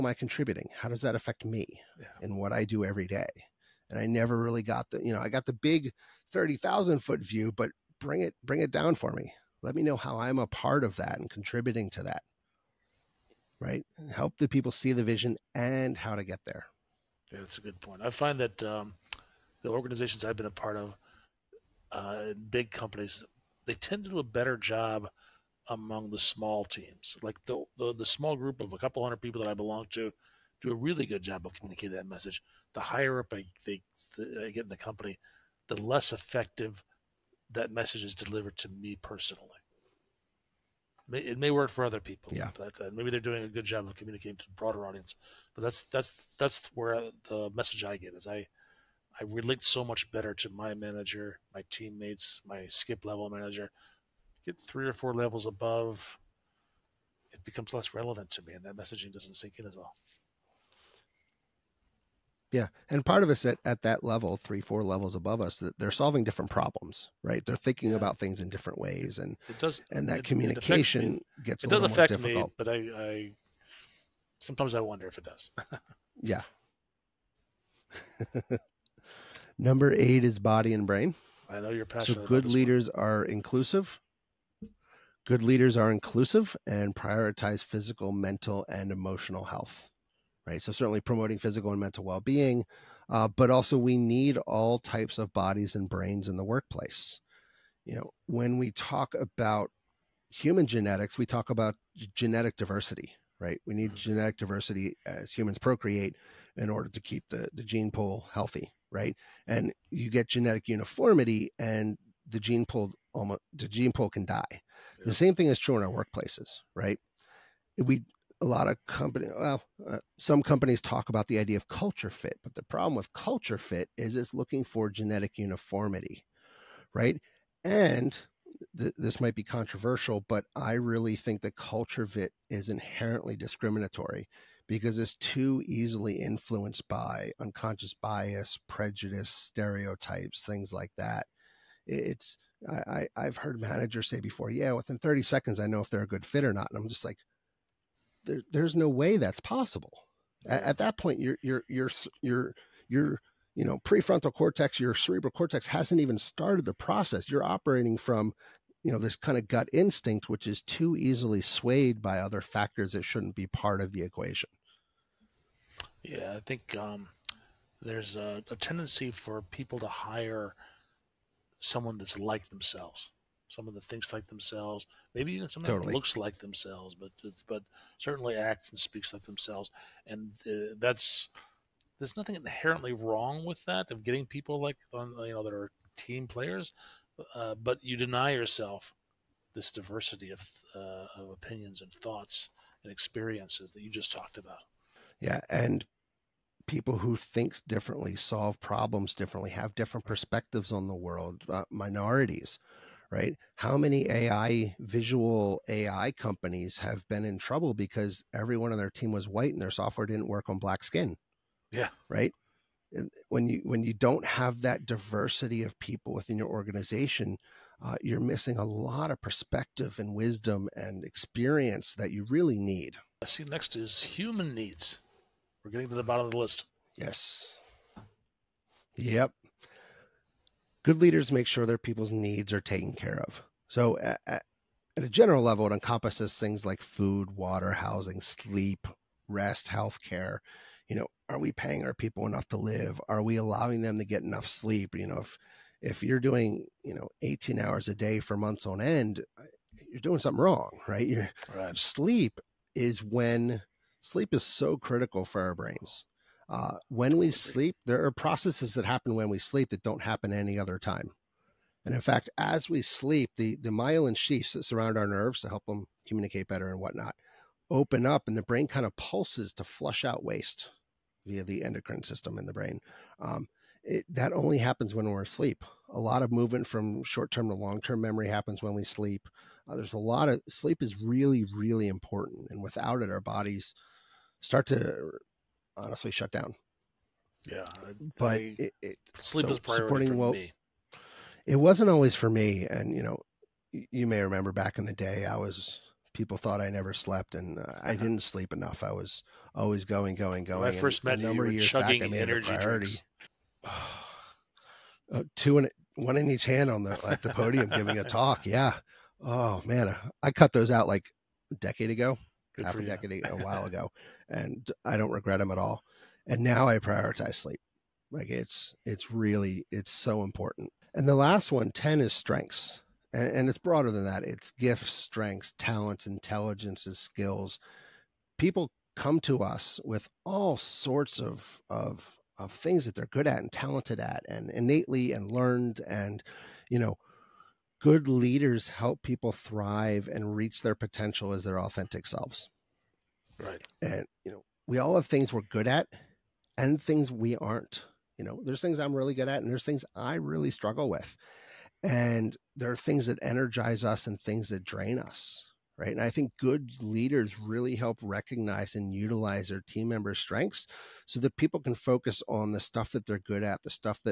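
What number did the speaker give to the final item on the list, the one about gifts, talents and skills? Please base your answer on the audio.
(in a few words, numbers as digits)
10.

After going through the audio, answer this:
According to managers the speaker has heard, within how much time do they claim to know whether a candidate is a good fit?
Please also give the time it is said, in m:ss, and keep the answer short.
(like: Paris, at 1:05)
30 seconds, at 2:24.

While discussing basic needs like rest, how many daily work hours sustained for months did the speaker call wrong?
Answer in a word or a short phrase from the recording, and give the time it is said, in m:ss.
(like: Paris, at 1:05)
18 hours, at 4:07.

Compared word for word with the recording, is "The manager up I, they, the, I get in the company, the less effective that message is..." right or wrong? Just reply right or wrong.
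wrong.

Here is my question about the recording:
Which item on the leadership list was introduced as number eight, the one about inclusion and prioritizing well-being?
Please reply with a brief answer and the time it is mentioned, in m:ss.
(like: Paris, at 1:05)
body and brain, at 1:20.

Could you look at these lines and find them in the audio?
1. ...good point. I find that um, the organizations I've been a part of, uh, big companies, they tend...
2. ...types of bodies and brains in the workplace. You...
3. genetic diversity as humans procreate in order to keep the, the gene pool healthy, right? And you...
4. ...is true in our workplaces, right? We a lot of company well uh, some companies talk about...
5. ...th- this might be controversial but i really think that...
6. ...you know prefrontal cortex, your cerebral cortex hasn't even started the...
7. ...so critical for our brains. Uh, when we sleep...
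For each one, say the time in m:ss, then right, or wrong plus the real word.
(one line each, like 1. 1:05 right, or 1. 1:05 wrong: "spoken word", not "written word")
1. 0:17 right
2. 1:34 right
3. 1:43 right
4. 1:55 right
5. 2:08 right
6. 2:33 right
7. 4:14 right.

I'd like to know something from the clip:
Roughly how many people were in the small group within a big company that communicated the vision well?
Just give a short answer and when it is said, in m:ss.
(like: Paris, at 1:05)
a couple hundred, at 0:28.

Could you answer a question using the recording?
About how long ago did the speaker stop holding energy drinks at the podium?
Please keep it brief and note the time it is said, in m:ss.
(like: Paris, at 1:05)
a decade ago, at 5:11.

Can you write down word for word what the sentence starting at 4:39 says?
Uh, there's a lot of sleep is really, really important.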